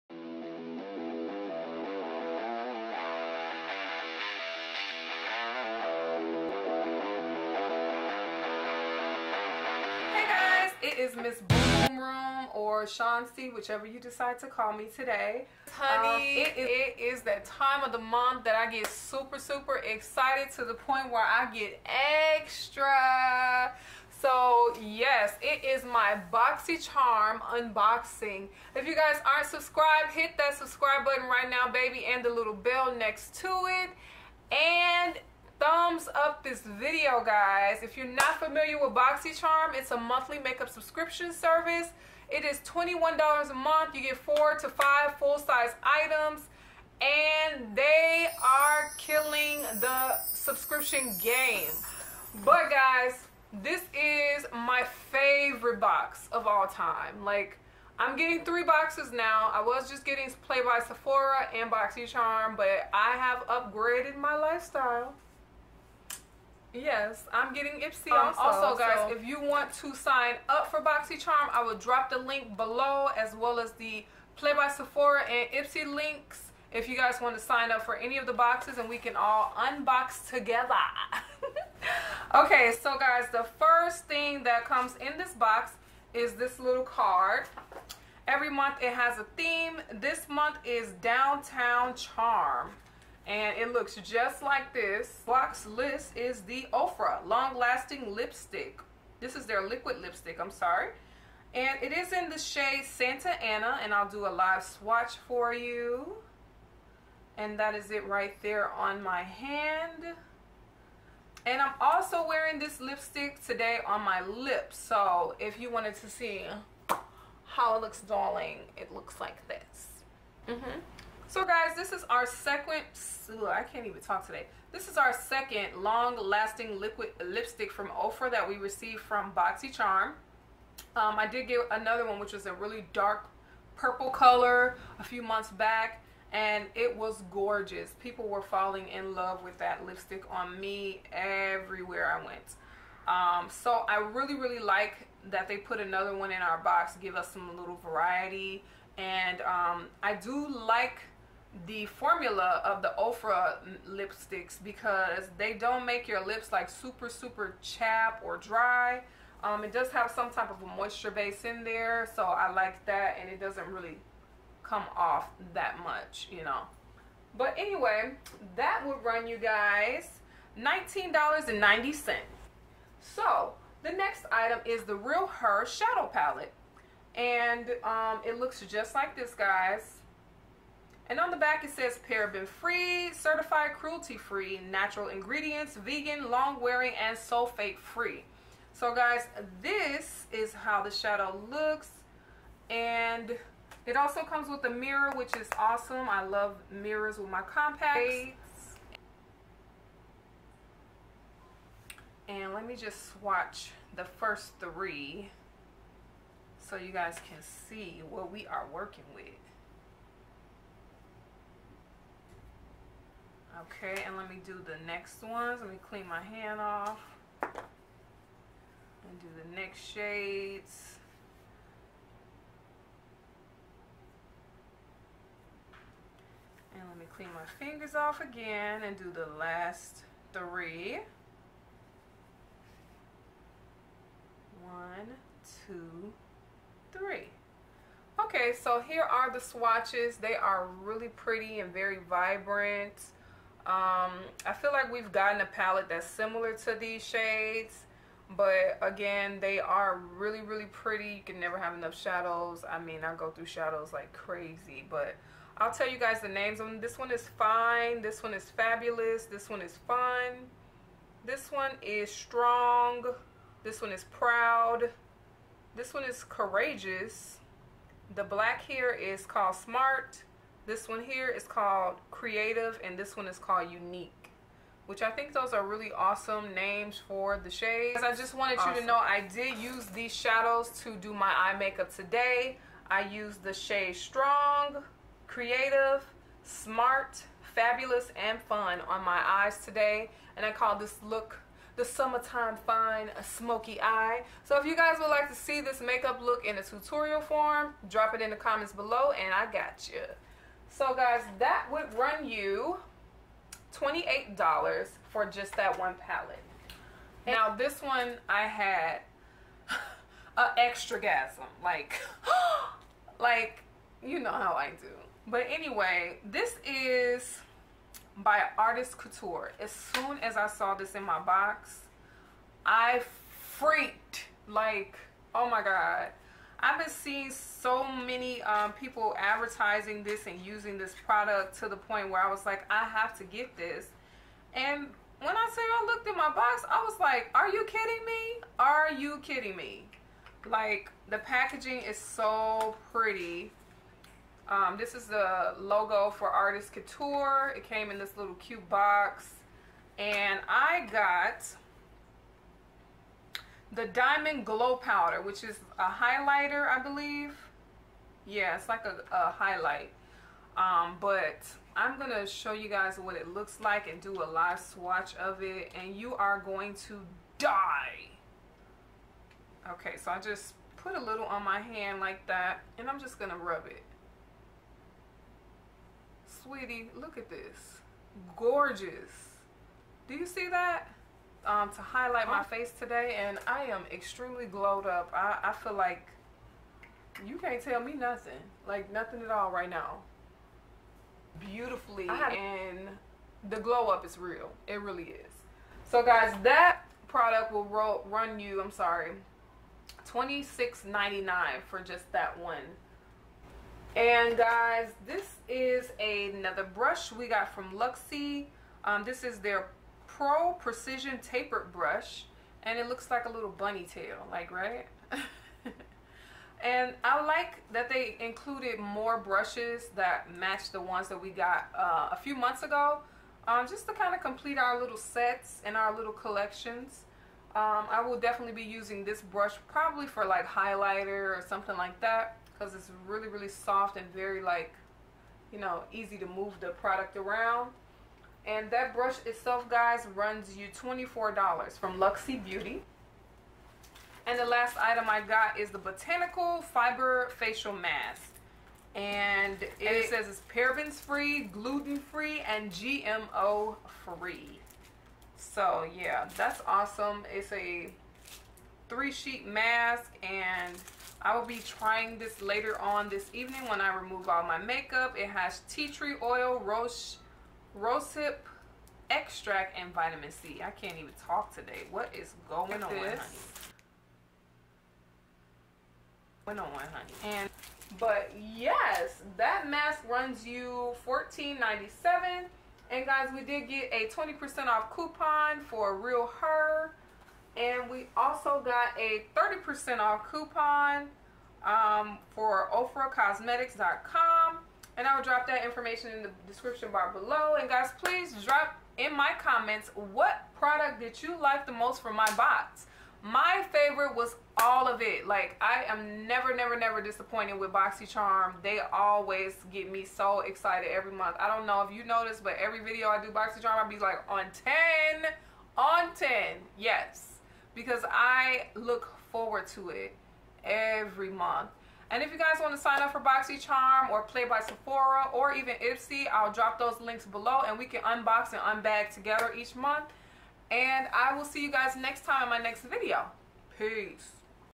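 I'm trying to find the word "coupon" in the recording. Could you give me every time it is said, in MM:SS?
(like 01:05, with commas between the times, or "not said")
08:04, 08:10.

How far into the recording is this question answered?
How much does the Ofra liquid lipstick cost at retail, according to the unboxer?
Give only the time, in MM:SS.
02:50.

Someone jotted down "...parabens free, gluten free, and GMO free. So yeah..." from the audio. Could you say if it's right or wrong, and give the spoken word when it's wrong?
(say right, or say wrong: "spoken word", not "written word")
right.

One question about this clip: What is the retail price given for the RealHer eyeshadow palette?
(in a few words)
$28.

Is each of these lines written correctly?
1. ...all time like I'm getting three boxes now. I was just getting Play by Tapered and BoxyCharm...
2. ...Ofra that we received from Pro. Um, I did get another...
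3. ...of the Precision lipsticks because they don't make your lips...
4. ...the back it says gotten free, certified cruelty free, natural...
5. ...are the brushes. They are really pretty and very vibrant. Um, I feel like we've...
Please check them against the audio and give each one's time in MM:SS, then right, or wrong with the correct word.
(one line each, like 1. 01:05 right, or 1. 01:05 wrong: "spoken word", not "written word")
1. 00:56 wrong: "Sephora", not "Tapered"
2. 02:07 wrong: "BoxyCharm", not "Pro"
3. 02:32 wrong: "Ofra", not "Precision"
4. 03:01 wrong: "paraben", not "gotten"
5. 03:59 wrong: "swatches", not "brushes".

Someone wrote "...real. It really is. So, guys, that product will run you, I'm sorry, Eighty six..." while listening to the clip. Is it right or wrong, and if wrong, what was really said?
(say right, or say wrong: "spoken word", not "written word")
wrong: "Twenty", not "Eighty".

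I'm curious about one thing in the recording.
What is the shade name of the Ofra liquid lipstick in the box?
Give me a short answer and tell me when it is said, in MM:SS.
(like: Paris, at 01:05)
Santa Ana, at 01:42.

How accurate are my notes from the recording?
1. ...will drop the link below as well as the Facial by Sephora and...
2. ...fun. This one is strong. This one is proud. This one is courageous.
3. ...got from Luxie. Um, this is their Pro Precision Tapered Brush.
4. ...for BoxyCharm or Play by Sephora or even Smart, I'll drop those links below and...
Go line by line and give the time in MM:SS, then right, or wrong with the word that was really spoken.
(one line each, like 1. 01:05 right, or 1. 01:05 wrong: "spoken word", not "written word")
1. 01:11 wrong: "Play", not "Facial"
2. 04:19 right
3. 06:47 right
4. 08:43 wrong: "Ipsy", not "Smart".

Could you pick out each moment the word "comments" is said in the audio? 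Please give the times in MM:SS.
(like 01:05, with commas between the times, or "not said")
04:58, 08:19.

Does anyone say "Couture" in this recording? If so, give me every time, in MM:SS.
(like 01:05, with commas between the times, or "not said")
05:18, 05:46.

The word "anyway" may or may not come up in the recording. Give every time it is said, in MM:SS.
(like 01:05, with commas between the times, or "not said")
02:47, 05:15.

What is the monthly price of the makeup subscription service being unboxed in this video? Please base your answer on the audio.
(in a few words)
$21.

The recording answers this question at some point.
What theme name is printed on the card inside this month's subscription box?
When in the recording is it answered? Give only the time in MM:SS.
01:31.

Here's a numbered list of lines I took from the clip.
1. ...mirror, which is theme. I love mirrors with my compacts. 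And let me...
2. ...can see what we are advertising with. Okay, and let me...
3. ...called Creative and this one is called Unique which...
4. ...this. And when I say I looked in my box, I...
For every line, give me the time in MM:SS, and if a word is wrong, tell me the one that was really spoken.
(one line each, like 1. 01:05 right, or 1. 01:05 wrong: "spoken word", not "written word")
1. 03:14 wrong: "awesome", not "theme"
2. 03:27 wrong: "working", not "advertising"
3. 04:31 right
4. 05:33 right.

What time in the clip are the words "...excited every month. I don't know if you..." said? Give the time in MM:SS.
08:30.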